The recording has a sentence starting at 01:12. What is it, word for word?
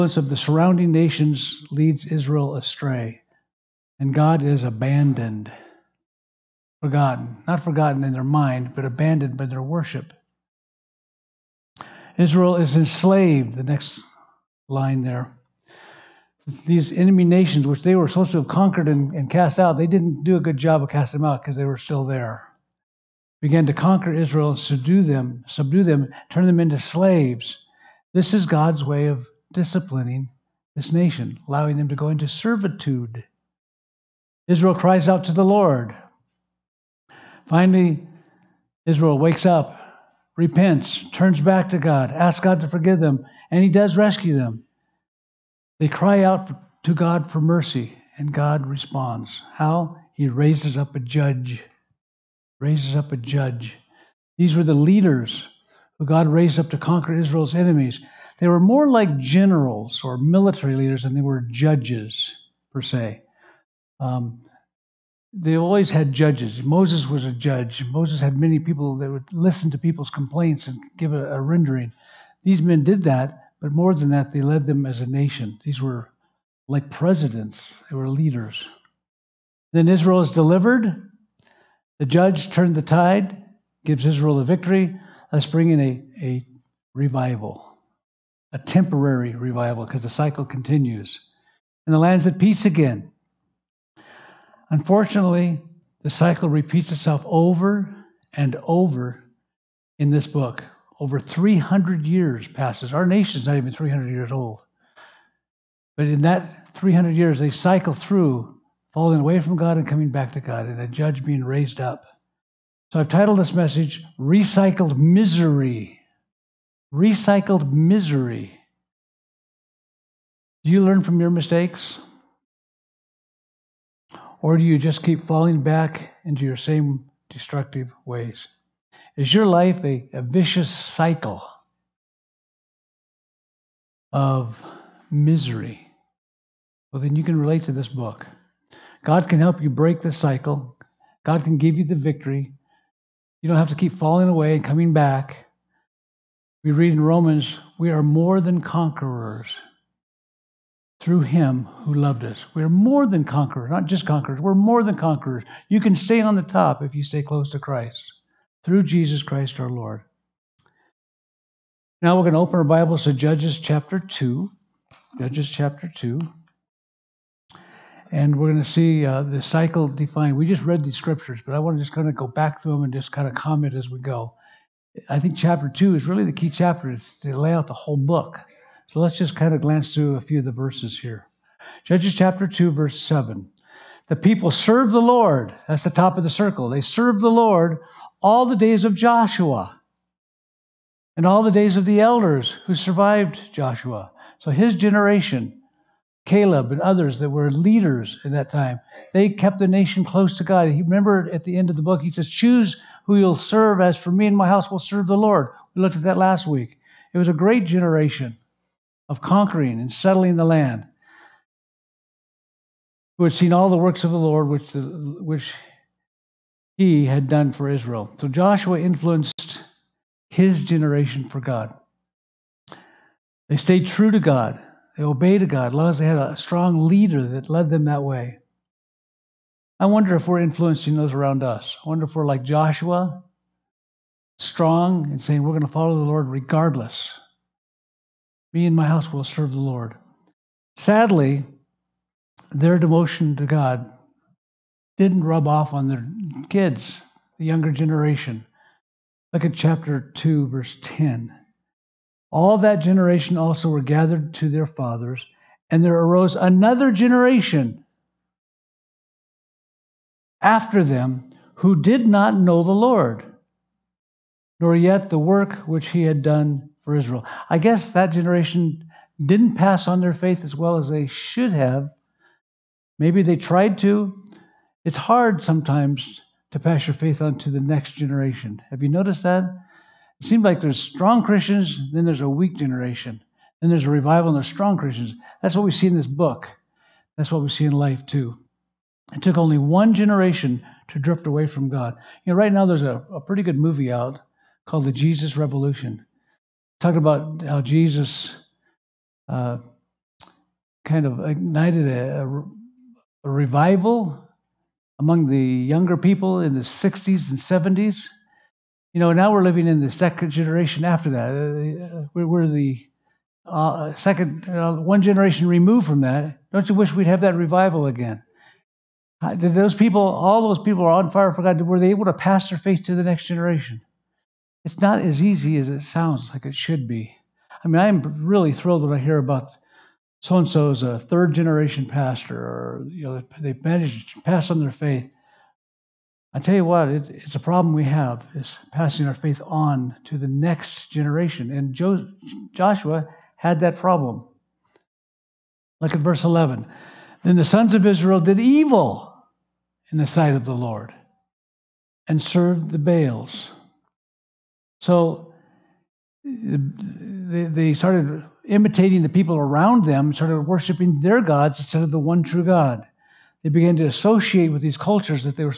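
These men did that, but more than that, they led them as a nation.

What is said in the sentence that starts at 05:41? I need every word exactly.
And jo- Joshua had that problem.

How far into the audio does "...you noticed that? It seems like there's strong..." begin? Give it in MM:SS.
04:38.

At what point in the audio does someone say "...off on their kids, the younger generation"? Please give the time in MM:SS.
04:05.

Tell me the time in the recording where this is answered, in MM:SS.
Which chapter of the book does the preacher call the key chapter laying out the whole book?
02:55.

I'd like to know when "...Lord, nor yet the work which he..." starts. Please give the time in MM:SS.
04:22.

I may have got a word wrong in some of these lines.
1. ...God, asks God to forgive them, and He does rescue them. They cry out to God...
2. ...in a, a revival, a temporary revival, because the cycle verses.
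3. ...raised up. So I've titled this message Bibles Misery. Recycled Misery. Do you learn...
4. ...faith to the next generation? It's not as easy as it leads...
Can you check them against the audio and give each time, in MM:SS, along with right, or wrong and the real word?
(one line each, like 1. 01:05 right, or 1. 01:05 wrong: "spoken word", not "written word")
1. 00:41 right
2. 01:25 wrong: "continues", not "verses"
3. 01:51 wrong: "Recycled", not "Bibles"
4. 05:22 wrong: "sounds", not "leads".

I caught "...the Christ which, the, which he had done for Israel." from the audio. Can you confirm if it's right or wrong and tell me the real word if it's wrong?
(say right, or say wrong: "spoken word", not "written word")
wrong: "Lord", not "Christ".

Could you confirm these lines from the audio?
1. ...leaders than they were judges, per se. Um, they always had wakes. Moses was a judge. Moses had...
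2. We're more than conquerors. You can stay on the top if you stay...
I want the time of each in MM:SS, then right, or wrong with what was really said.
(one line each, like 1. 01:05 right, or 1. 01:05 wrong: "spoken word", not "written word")
1. 01:00 wrong: "judges", not "wakes"
2. 02:34 right.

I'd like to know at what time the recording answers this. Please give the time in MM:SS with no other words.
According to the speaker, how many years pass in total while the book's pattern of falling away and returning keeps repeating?
01:40.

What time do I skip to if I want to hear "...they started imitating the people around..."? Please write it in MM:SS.
05:57.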